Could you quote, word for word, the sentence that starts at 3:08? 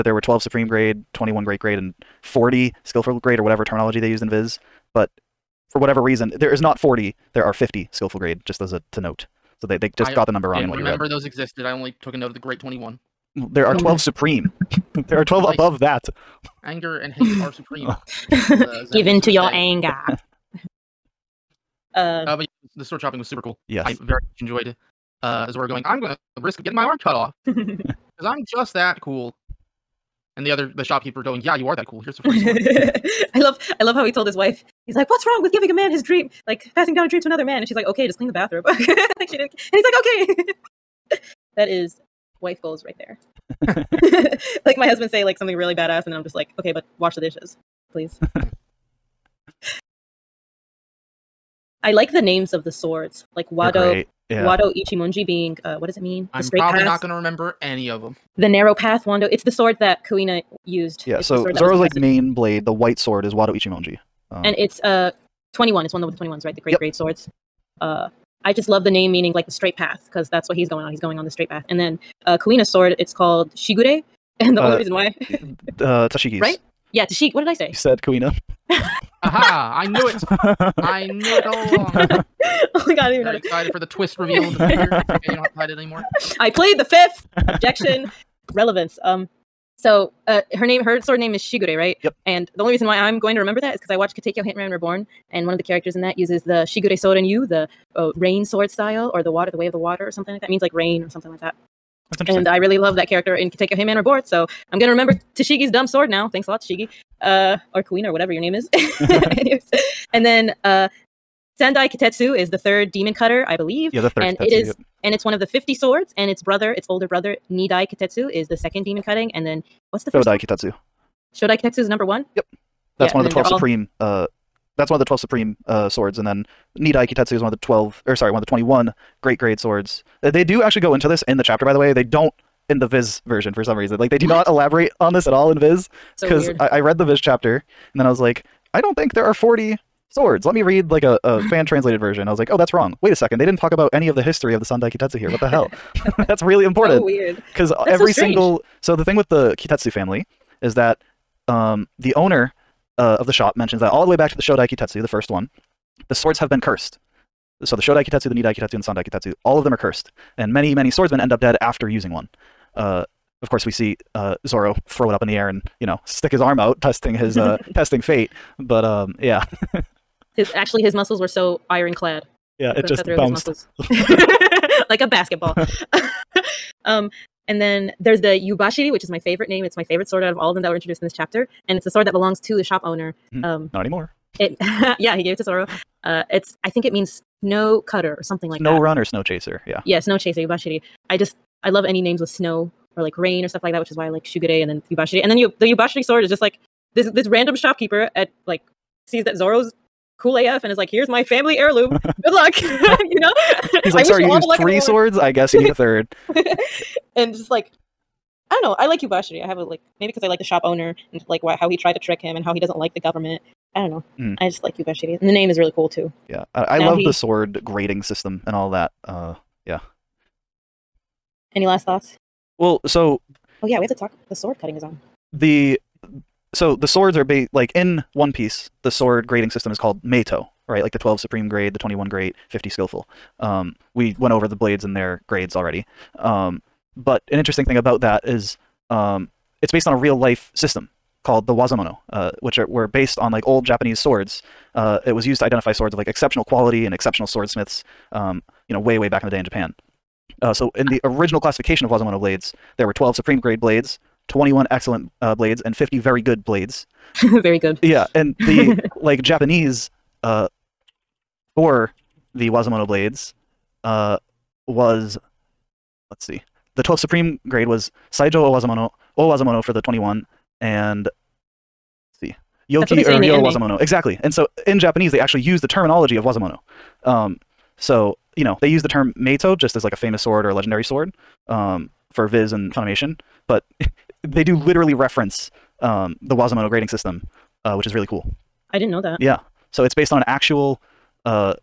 Snow run or snow chaser, yeah.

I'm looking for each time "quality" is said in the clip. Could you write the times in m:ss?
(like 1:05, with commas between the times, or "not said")
4:06.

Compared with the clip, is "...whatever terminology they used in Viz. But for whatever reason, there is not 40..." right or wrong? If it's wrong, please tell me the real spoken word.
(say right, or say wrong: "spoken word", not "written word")
right.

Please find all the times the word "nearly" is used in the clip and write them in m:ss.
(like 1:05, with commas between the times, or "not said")
not said.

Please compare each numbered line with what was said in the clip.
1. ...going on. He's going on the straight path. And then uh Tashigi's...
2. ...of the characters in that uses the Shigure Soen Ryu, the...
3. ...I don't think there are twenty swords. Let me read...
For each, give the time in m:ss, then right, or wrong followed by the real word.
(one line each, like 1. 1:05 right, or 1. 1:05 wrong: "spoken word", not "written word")
1. 1:10 wrong: "Kuina", not "Tashigi"
2. 1:35 right
3. 2:18 wrong: "forty", not "twenty".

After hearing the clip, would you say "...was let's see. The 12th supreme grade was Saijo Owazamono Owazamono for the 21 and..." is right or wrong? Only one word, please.
right.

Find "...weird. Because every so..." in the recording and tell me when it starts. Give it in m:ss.
2:27.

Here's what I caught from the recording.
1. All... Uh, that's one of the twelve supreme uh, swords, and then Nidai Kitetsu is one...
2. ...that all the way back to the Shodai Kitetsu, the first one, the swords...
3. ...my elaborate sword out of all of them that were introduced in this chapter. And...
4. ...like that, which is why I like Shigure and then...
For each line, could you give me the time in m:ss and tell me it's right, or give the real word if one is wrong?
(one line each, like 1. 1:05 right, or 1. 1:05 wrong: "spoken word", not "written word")
1. 2:03 right
2. 2:33 right
3. 2:59 wrong: "favorite", not "elaborate"
4. 3:13 right.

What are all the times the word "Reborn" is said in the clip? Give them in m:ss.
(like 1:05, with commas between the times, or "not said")
1:34, 1:43.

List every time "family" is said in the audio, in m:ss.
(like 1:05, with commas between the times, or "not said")
2:29, 3:21.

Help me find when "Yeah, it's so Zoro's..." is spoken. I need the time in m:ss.
1:01.